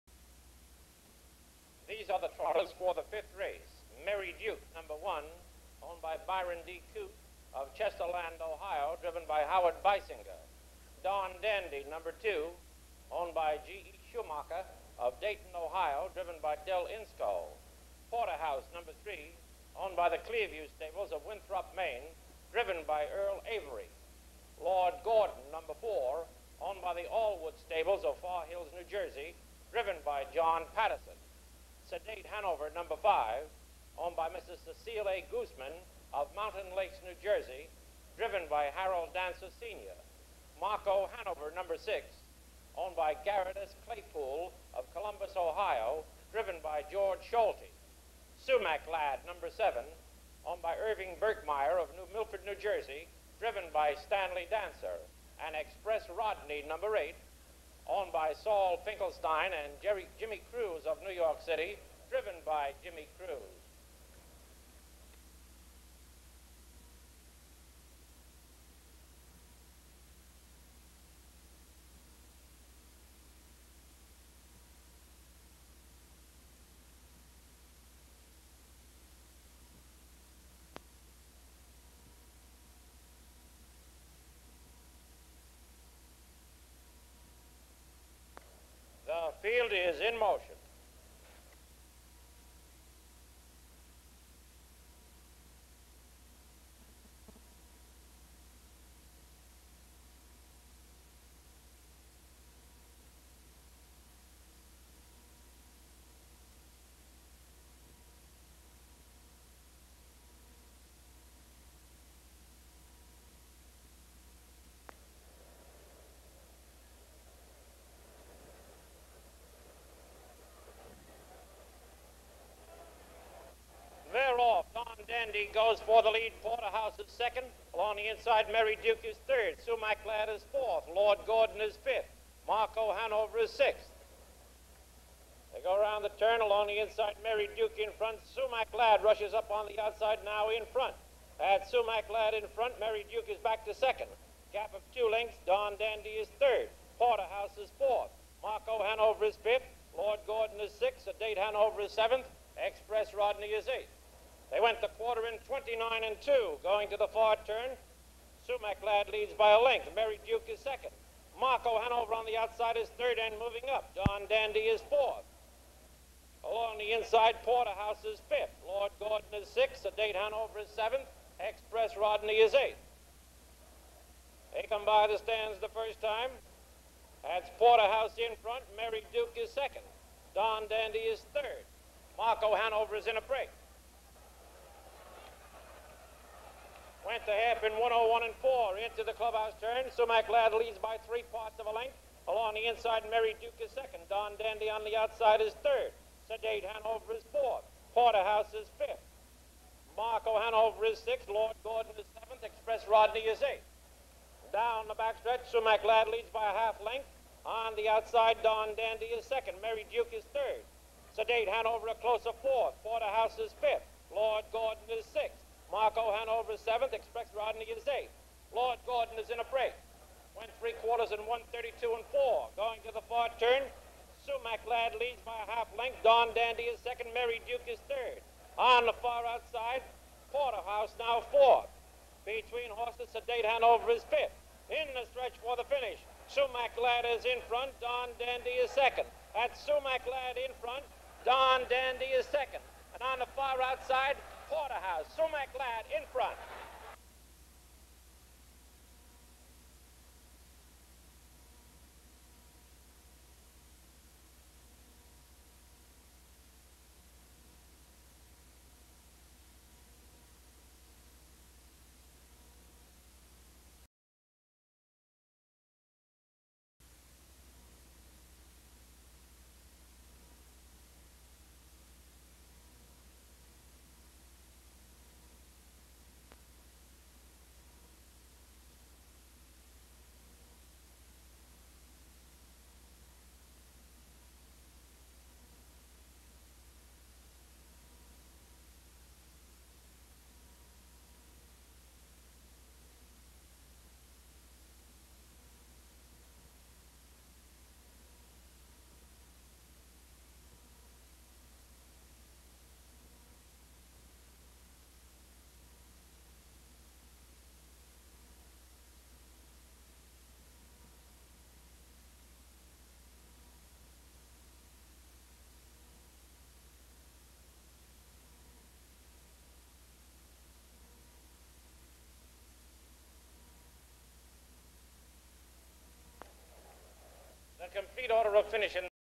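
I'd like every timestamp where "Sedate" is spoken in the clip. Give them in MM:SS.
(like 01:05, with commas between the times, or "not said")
00:31, 03:16, 03:31, 03:53.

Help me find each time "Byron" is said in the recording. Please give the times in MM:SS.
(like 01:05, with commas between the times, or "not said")
00:06.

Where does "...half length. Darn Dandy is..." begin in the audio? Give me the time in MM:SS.
03:45.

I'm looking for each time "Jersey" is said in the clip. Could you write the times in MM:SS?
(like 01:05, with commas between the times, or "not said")
00:28, 00:37, 00:52.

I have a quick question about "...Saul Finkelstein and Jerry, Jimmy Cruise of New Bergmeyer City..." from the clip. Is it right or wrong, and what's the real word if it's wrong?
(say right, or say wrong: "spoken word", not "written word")
wrong: "York", not "Bergmeyer".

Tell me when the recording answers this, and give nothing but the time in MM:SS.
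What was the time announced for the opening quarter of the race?
02:35.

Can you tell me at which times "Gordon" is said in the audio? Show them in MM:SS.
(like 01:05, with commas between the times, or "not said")
00:25, 02:11, 02:30, 02:48, 03:21, 03:34, 03:38.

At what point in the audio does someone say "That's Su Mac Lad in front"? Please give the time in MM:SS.
03:59.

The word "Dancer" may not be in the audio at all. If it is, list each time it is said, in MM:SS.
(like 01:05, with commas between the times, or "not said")
00:39, 00:54.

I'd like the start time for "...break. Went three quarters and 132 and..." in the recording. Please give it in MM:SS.
03:39.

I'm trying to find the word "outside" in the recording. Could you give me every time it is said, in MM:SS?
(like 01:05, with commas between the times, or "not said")
02:19, 02:42, 03:14, 03:27, 03:49, 04:03.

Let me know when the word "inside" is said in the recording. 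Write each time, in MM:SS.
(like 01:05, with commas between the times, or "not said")
02:08, 02:16, 02:46, 03:12.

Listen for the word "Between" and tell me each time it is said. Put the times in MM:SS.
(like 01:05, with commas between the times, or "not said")
03:52.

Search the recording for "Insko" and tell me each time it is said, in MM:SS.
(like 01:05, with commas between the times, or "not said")
00:16.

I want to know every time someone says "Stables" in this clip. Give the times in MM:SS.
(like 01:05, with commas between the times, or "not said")
00:20, 00:27.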